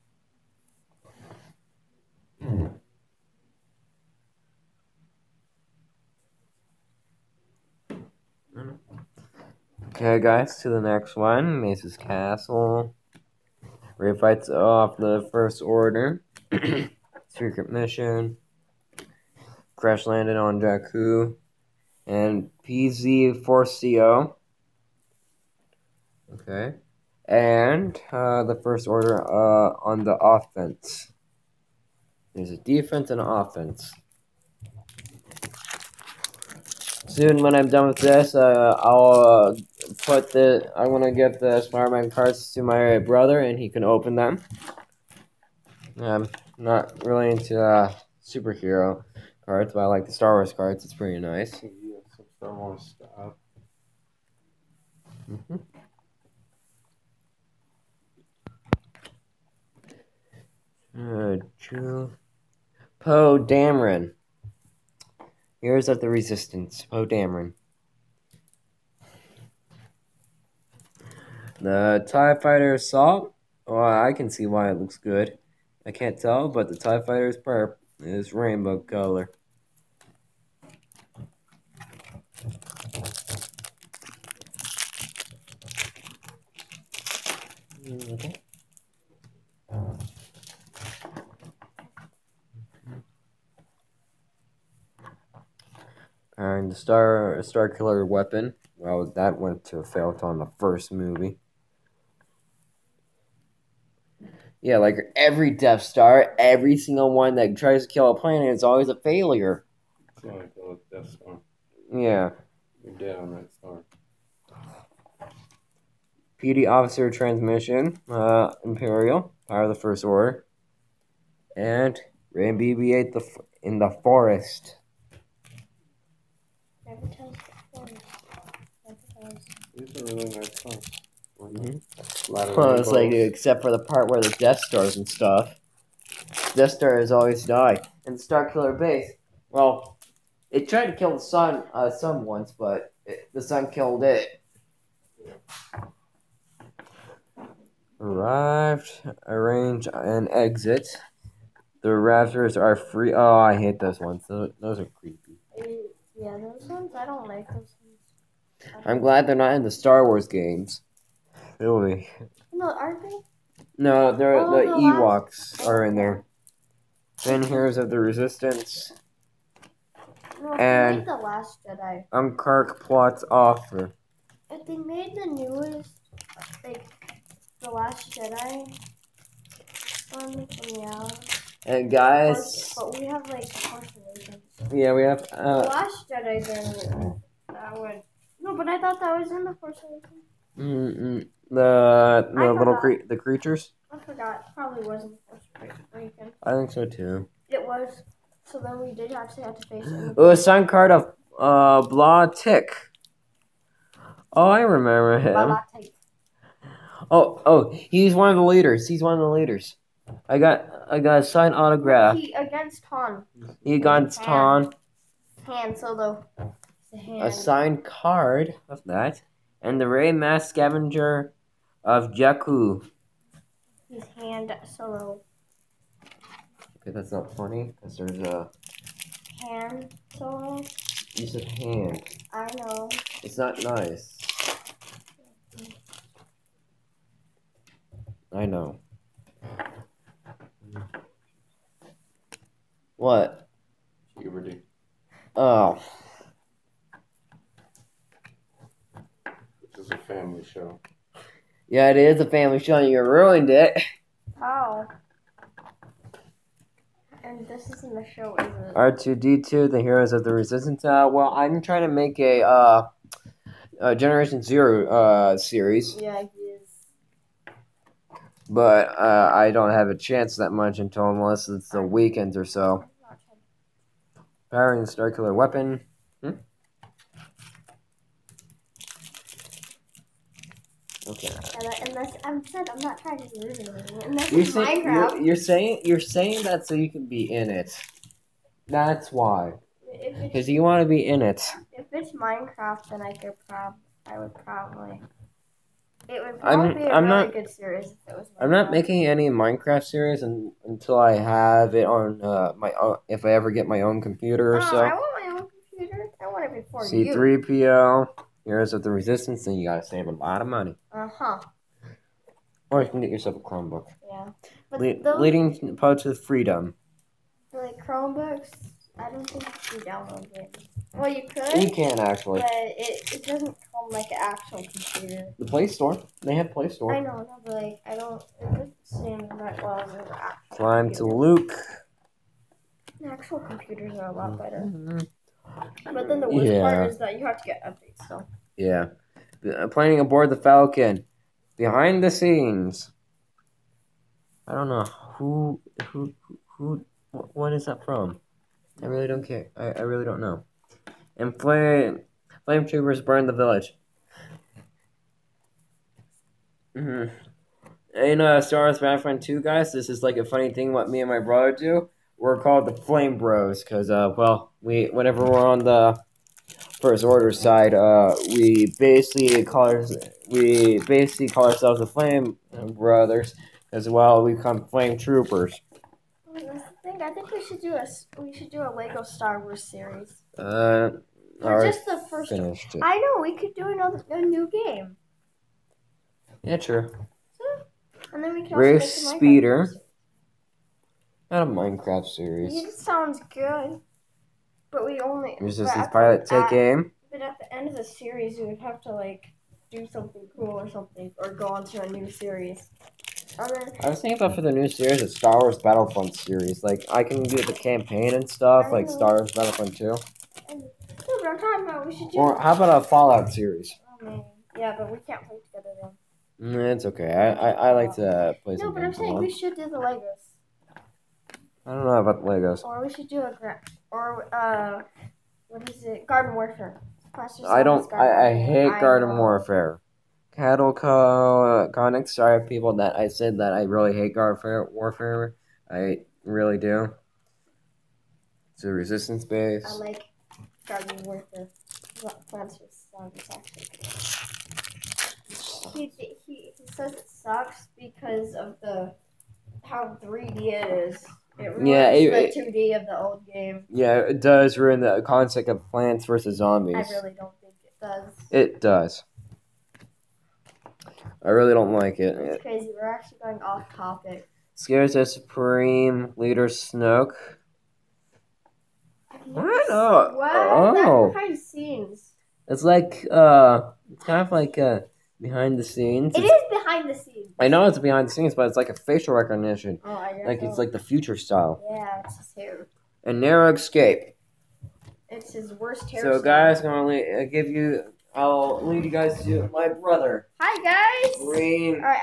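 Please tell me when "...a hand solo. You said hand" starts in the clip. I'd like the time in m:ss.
3:48.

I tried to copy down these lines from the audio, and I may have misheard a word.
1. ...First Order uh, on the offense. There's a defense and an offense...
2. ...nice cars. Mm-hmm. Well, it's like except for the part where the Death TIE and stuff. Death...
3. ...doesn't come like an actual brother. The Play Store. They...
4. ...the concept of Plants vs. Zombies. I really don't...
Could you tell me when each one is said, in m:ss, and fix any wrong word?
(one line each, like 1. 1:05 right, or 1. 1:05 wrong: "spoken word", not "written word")
1. 0:28 right
2. 2:10 wrong: "Stars", not "TIE"
3. 5:23 wrong: "computer", not "brother"
4. 7:34 right.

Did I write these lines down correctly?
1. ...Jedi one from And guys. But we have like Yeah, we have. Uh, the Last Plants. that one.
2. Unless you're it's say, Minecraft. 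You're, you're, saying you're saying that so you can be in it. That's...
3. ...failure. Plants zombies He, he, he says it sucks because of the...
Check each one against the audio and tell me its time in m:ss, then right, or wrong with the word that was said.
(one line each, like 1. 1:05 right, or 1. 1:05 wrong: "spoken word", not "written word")
1. 2:58 wrong: "Jedi", not "Plants"
2. 4:44 right
3. 7:21 wrong: "warfare", not "failure".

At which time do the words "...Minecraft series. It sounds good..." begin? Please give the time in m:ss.
6:31.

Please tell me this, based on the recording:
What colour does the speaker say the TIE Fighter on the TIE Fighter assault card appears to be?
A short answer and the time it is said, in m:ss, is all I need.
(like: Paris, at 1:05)
Purple, at 1:17.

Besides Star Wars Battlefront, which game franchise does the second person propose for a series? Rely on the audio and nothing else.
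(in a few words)
Fallout.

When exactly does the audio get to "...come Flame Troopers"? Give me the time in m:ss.
6:14.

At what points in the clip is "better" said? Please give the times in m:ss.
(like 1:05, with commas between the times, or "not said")
5:34.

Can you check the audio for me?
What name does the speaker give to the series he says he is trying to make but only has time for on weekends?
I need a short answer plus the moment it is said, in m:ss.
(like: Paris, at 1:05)
Generation Zero, at 4:23.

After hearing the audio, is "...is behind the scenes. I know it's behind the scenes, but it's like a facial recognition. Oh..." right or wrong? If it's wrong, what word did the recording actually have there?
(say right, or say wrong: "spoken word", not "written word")
right.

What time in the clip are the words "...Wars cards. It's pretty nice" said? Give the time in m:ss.
0:50.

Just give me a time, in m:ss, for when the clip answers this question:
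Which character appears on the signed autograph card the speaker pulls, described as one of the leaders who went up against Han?
3:21.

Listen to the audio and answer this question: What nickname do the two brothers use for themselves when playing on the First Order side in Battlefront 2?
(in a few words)
Flame Bros.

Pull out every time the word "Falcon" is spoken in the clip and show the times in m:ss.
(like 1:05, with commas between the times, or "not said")
5:40.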